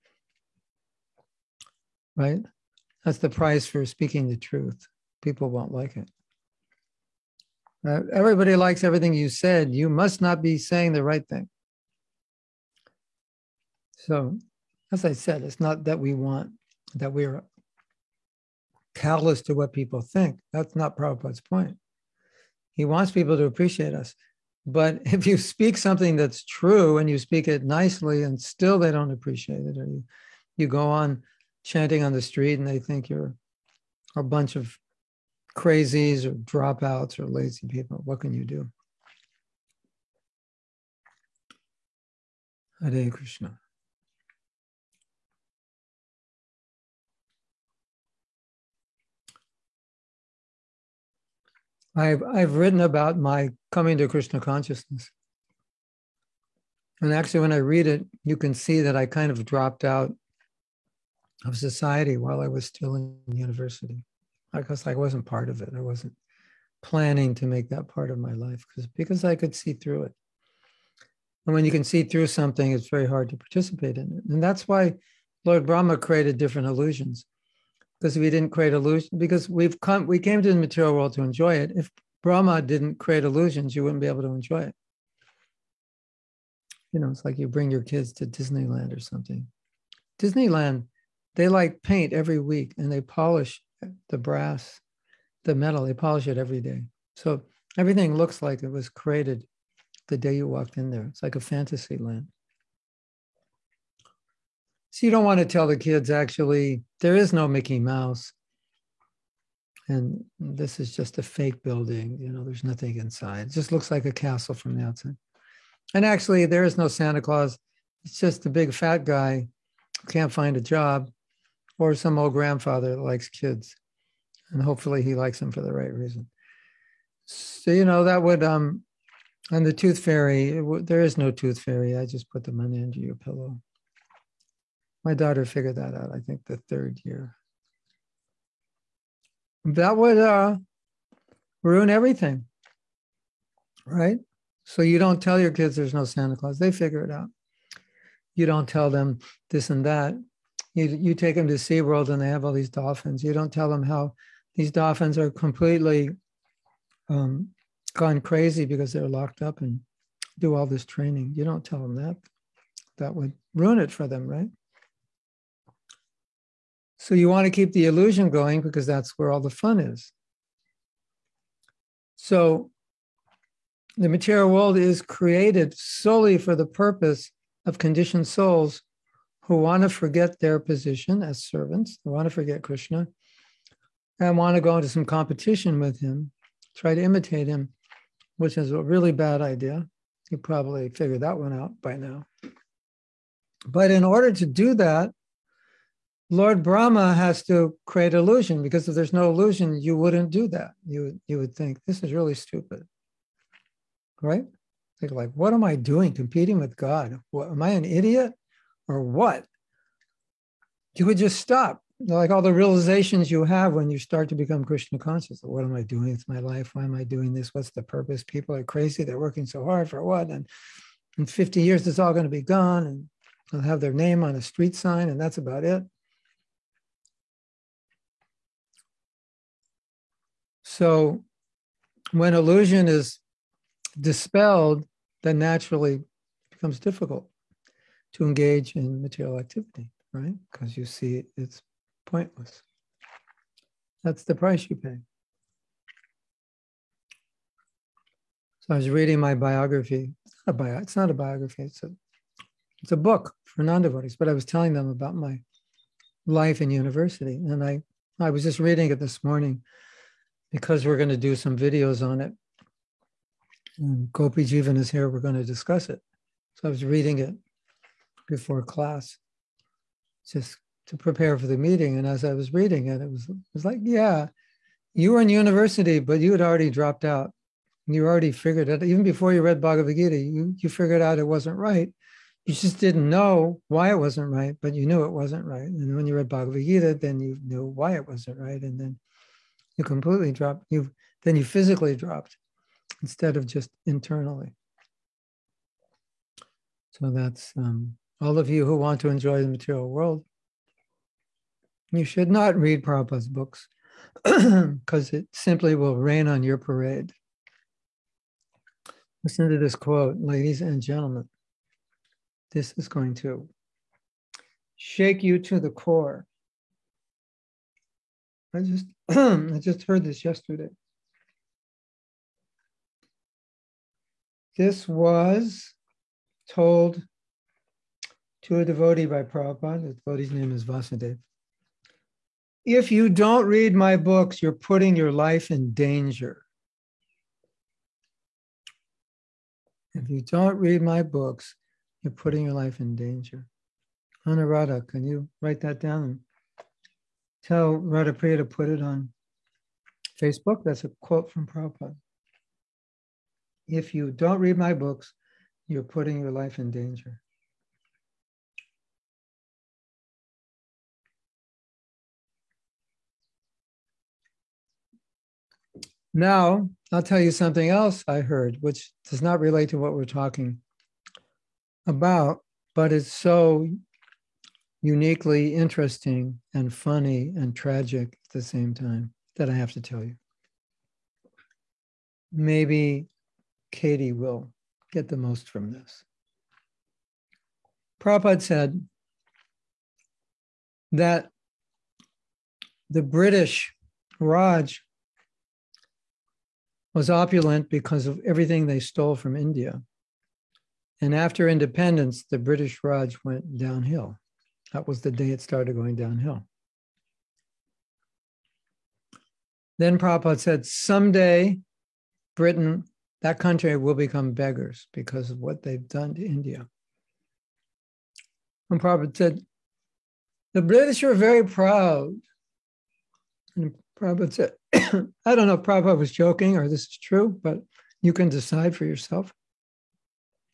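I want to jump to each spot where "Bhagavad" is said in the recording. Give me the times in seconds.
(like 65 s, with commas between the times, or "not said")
279 s, 286 s.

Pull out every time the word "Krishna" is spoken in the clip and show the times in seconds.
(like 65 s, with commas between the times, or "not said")
43 s, 54 s, 182 s, 214 s.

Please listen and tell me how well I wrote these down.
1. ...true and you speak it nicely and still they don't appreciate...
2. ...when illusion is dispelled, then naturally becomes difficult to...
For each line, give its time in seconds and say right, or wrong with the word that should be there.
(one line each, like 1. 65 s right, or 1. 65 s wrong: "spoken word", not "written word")
1. 26 s right
2. 232 s right.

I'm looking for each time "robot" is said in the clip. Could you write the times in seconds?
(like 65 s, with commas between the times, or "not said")
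not said.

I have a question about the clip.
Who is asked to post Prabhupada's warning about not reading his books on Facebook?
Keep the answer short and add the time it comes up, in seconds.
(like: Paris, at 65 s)
Radhapriya, at 347 s.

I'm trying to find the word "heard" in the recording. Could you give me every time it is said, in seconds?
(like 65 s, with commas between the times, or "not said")
319 s, 368 s.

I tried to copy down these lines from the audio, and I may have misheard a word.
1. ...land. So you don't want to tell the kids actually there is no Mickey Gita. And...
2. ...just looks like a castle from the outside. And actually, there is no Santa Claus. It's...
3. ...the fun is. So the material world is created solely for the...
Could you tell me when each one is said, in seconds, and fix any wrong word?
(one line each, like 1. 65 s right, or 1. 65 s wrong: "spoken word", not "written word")
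1. 101 s wrong: "Mouse", not "Gita"
2. 113 s right
3. 169 s right.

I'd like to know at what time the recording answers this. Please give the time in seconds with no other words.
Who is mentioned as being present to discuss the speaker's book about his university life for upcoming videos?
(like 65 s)
264 s.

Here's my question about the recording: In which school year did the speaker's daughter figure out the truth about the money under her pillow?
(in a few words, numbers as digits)
3rd year.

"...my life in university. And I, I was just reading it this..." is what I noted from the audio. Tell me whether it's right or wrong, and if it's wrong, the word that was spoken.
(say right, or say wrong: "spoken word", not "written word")
right.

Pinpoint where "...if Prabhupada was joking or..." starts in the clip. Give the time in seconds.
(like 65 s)
425 s.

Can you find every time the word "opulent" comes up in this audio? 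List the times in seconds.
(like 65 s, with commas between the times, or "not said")
397 s.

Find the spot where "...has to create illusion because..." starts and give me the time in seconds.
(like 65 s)
197 s.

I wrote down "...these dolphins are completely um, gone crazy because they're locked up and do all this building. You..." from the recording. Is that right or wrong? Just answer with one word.
wrong.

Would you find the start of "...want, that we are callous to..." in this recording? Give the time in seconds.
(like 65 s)
16 s.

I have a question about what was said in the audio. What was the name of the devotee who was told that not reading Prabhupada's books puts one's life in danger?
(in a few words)
Vasudev.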